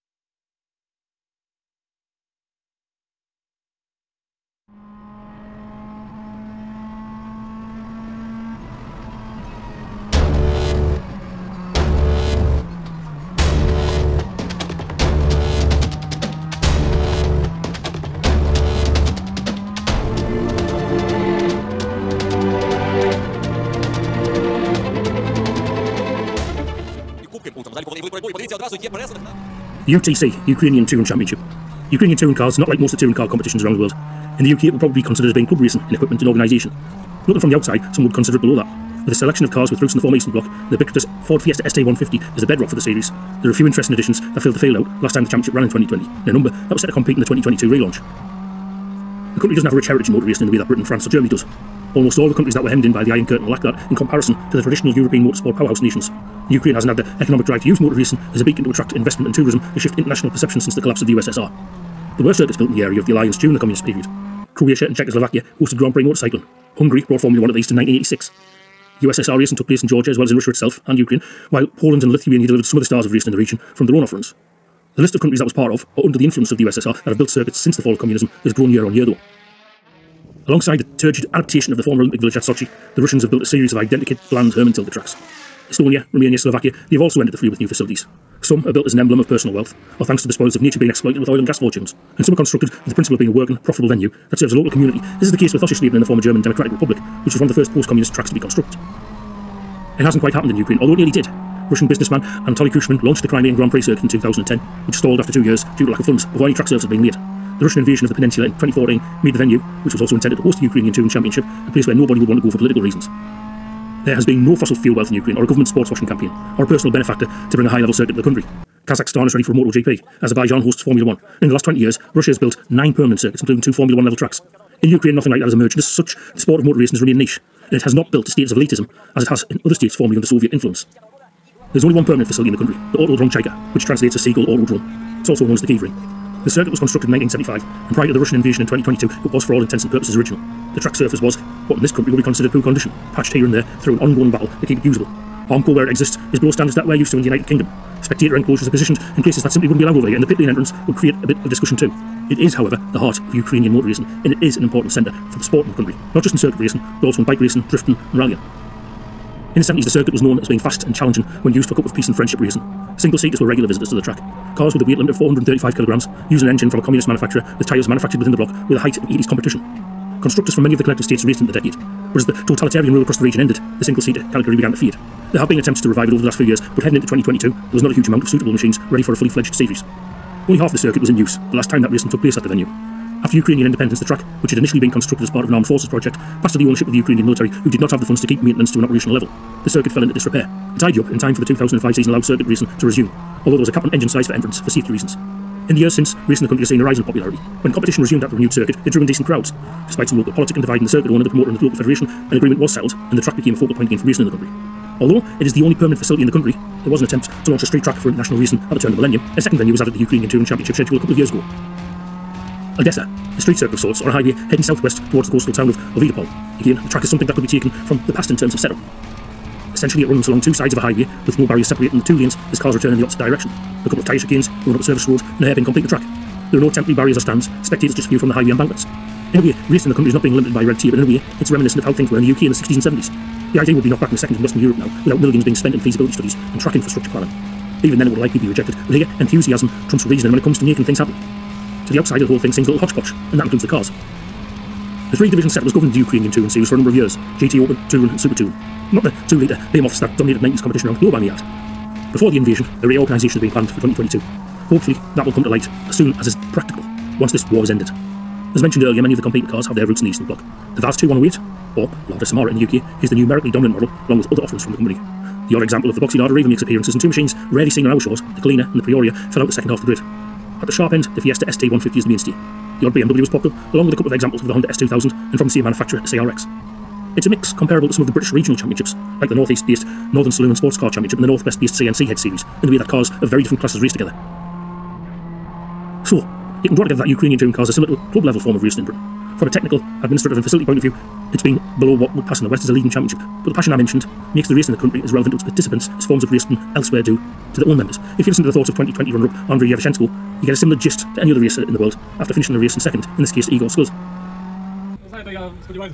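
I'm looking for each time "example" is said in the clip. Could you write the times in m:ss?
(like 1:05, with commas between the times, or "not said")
4:25, 4:34.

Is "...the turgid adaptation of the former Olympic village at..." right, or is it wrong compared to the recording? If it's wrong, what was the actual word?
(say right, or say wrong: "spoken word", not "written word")
right.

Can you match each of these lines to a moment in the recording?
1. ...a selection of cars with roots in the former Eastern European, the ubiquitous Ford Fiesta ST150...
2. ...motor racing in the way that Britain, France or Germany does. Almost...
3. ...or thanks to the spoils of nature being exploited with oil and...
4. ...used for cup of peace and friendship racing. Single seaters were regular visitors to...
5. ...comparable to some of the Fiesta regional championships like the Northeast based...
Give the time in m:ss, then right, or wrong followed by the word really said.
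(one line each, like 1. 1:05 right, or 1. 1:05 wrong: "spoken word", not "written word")
1. 0:39 wrong: "Bloc", not "European"
2. 0:50 right
3. 1:29 right
4. 2:41 right
5. 4:37 wrong: "British", not "Fiesta".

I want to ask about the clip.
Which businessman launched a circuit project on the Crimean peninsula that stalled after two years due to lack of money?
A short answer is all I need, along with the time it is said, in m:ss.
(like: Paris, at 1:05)
Anatoly Kushman, at 1:42.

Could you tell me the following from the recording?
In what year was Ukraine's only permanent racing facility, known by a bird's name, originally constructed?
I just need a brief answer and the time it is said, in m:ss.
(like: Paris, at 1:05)
1975, at 2:17.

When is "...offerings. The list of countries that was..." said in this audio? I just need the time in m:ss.
1:14.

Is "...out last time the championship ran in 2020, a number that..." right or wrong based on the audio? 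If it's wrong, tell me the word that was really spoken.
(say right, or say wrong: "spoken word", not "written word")
right.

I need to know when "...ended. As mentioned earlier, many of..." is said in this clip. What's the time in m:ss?
4:17.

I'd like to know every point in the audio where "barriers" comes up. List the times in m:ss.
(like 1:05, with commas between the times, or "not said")
3:41, 3:46.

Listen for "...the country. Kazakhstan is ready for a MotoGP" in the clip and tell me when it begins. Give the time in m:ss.
1:58.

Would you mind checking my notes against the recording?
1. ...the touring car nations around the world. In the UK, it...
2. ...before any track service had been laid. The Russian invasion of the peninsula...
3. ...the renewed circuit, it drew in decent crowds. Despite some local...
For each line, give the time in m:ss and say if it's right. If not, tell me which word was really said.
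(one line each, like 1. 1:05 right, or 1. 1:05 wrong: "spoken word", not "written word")
1. 0:32 wrong: "competitions", not "nations"
2. 1:46 right
3. 3:18 right.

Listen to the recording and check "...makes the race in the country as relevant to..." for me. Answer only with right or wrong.
right.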